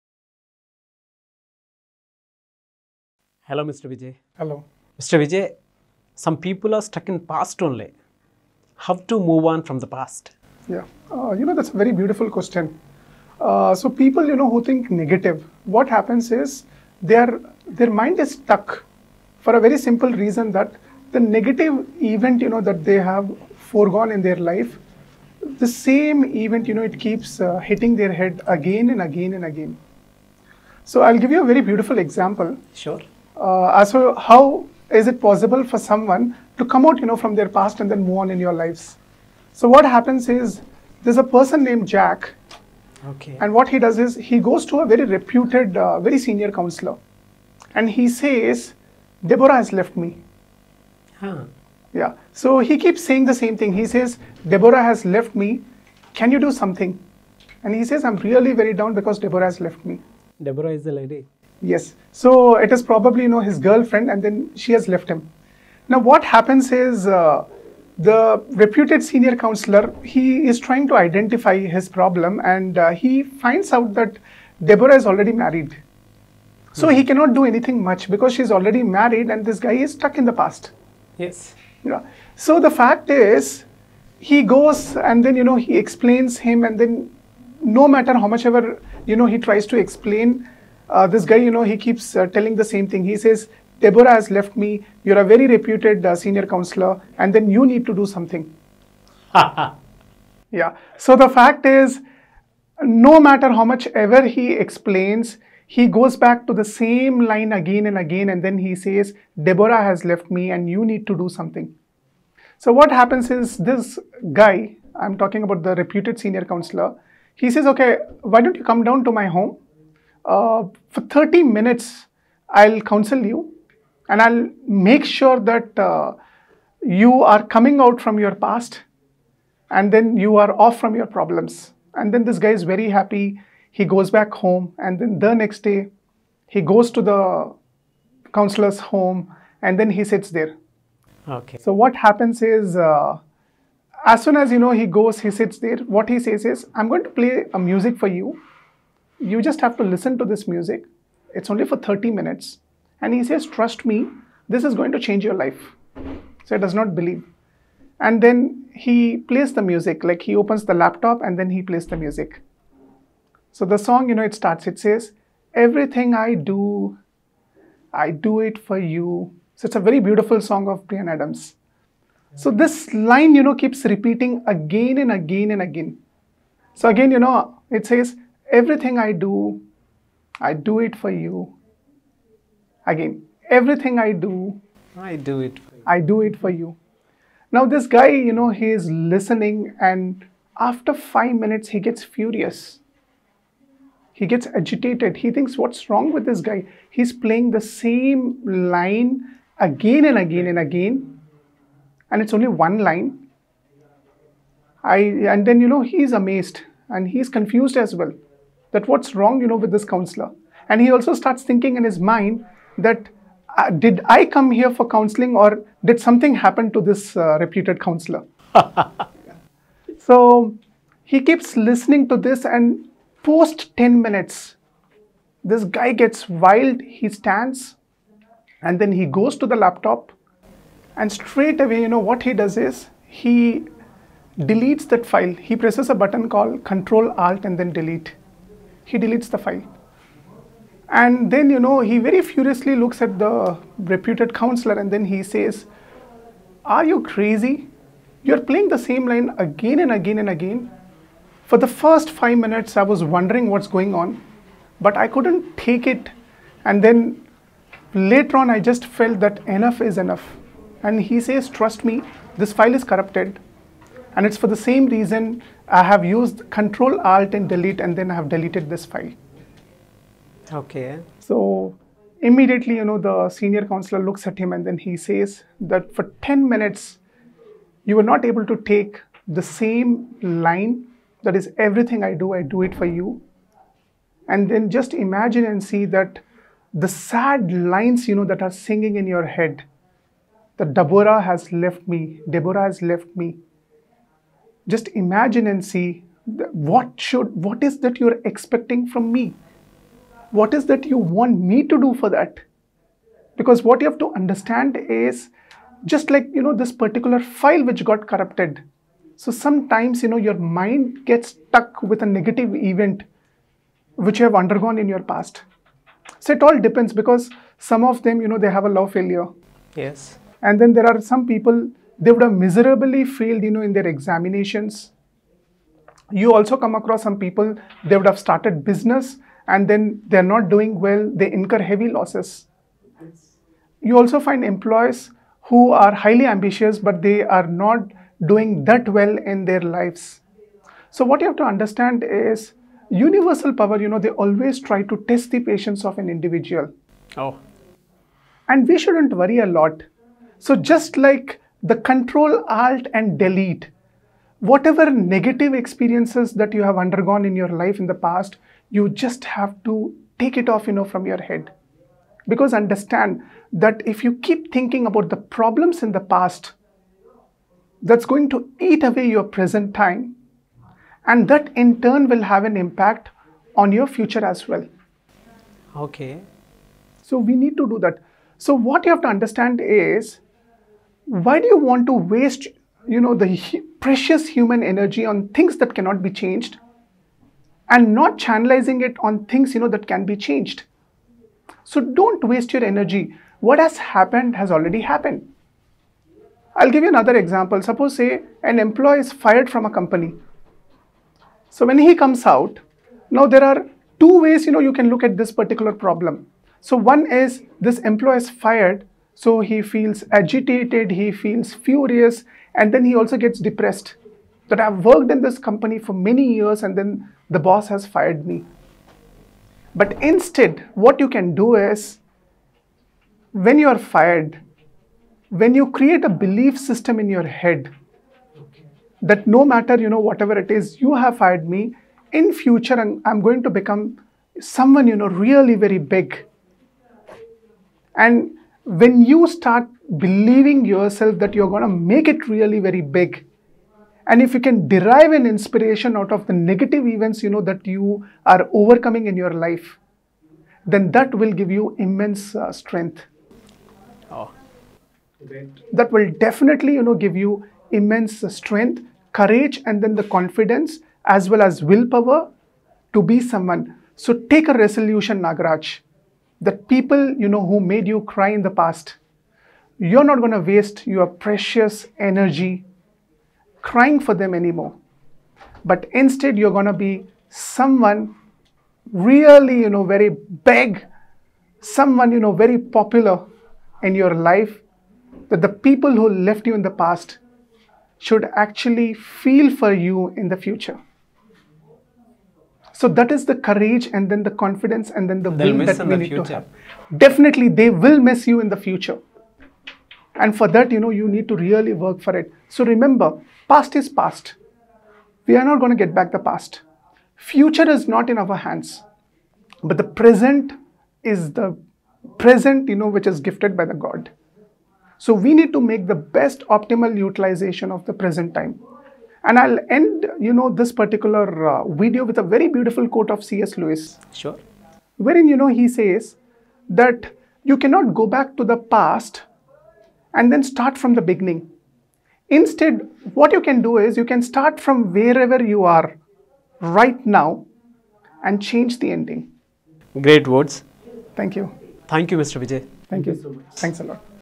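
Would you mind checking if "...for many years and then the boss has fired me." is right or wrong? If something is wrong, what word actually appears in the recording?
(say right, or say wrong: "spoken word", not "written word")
right.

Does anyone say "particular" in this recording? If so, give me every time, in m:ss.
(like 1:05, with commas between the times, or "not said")
5:06, 6:45, 8:40.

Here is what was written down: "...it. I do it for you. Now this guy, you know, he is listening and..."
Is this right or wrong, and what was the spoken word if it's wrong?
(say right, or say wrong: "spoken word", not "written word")
right.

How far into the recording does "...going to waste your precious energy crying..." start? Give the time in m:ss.
7:50.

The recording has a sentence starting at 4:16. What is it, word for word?
And then later on, I just felt that enough is enough.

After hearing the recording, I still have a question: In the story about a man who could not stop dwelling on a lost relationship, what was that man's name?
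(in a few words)
Jack.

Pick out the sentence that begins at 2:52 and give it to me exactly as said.
So this line, you know, keeps repeating again and again and again.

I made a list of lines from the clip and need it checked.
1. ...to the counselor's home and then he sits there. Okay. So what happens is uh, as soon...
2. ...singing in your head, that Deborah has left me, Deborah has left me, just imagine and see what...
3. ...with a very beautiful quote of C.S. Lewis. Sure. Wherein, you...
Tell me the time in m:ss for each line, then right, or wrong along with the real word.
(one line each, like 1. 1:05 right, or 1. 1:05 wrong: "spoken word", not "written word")
1. 2:16 right
2. 4:48 right
3. 8:42 right.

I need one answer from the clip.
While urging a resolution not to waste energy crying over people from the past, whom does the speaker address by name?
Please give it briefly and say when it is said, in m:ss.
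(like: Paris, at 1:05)
Nagaraj, at 7:45.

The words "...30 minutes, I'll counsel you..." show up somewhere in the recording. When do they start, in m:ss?
2:01.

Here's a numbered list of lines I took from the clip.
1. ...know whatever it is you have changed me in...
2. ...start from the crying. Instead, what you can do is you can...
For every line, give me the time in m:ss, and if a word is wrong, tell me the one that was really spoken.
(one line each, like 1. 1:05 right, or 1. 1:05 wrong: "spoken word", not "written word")
1. 7:09 wrong: "fired", not "changed"
2. 8:50 wrong: "beginning", not "crying".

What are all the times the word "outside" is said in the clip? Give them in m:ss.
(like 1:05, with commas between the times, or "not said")
not said.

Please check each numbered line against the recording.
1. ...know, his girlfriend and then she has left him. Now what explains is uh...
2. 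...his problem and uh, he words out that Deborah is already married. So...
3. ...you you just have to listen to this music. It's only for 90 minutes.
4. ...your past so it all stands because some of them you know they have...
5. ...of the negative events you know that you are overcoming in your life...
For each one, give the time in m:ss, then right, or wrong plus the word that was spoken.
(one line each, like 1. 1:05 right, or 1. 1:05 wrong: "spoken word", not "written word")
1. 1:03 wrong: "happens", not "explains"
2. 1:11 wrong: "finds", not "words"
3. 2:28 wrong: "30", not "90"
4. 5:14 wrong: "depends", not "stands"
5. 7:26 right.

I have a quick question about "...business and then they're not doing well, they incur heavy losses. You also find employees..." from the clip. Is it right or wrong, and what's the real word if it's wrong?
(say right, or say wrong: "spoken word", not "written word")
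right.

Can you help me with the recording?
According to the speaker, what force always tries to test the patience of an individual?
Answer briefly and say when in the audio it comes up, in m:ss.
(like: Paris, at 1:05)
Universal power, at 5:42.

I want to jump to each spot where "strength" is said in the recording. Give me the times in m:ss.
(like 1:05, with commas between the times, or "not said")
7:32, 7:38.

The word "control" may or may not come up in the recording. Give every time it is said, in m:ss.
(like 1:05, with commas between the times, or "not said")
3:56, 4:26, 5:51.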